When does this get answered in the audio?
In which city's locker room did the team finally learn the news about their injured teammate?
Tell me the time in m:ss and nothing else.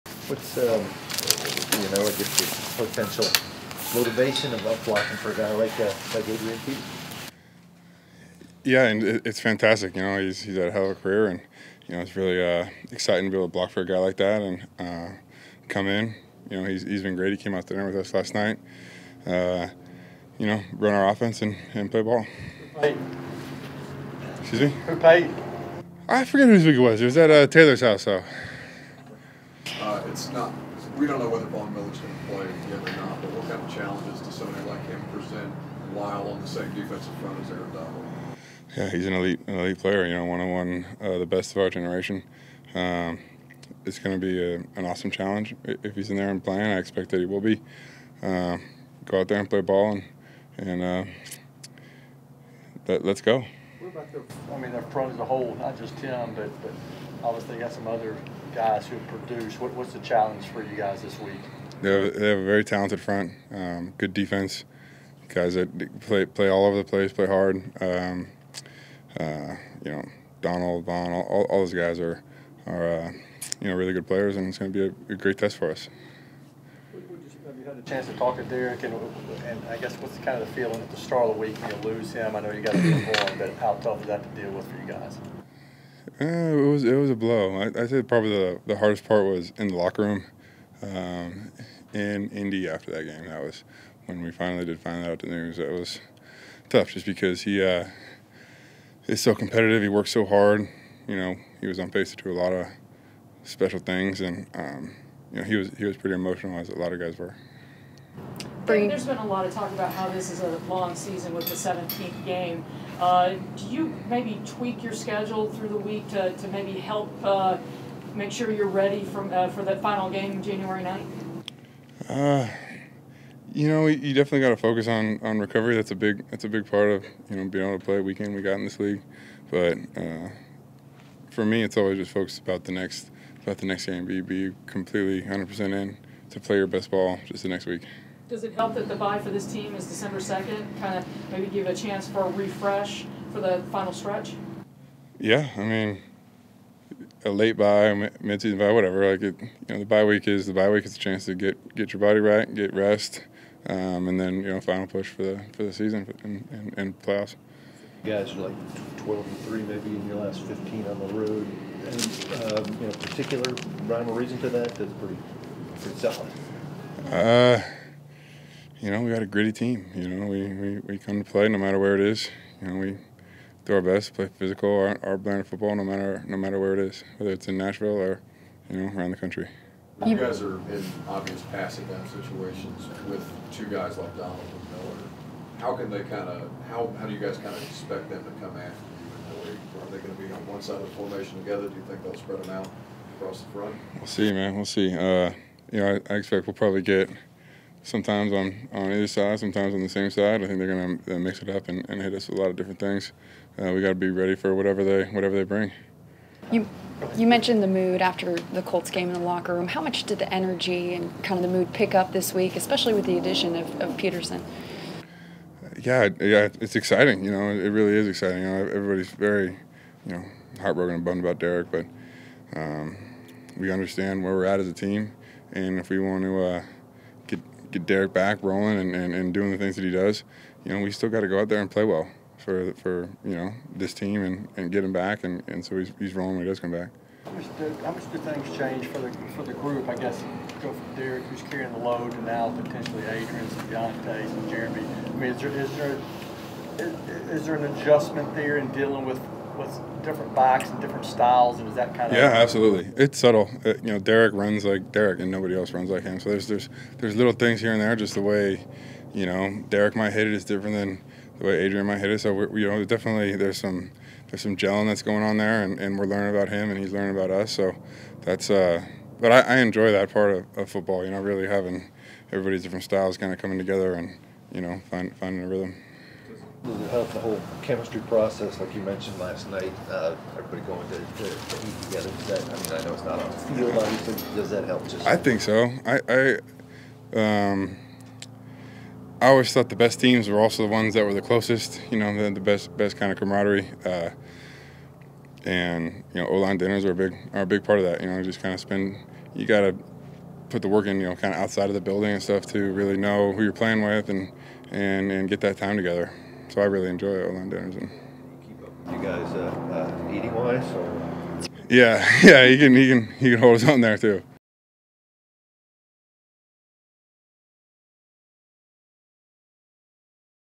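1:32.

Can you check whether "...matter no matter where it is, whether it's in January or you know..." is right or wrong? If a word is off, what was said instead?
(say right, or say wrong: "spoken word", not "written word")
wrong: "Nashville", not "January".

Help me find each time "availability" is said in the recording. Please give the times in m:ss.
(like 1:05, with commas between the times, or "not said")
not said.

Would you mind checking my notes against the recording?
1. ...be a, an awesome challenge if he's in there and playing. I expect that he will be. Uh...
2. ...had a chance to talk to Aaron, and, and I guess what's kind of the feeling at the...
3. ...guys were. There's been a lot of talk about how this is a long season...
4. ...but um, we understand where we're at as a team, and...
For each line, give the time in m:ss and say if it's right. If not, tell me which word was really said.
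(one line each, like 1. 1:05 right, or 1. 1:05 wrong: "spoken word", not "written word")
1. 0:44 right
2. 1:17 wrong: "Derek", not "Aaron"
3. 1:46 right
4. 3:41 right.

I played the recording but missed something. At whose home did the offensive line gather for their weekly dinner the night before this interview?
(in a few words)
Taylor's house.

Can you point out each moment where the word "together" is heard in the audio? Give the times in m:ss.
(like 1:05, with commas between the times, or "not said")
3:11, 4:33, 4:41, 5:05.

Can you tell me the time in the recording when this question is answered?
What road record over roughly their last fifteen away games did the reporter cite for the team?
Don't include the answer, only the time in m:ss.
2:39.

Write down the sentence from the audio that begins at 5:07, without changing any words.
And you guys uh, uh, eating wise?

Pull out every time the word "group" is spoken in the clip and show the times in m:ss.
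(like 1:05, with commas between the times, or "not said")
3:59.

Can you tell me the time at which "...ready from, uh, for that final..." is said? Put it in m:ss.
1:58.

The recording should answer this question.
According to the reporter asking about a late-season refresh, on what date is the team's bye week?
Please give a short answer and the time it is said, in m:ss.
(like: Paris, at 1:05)
December 2, at 2:19.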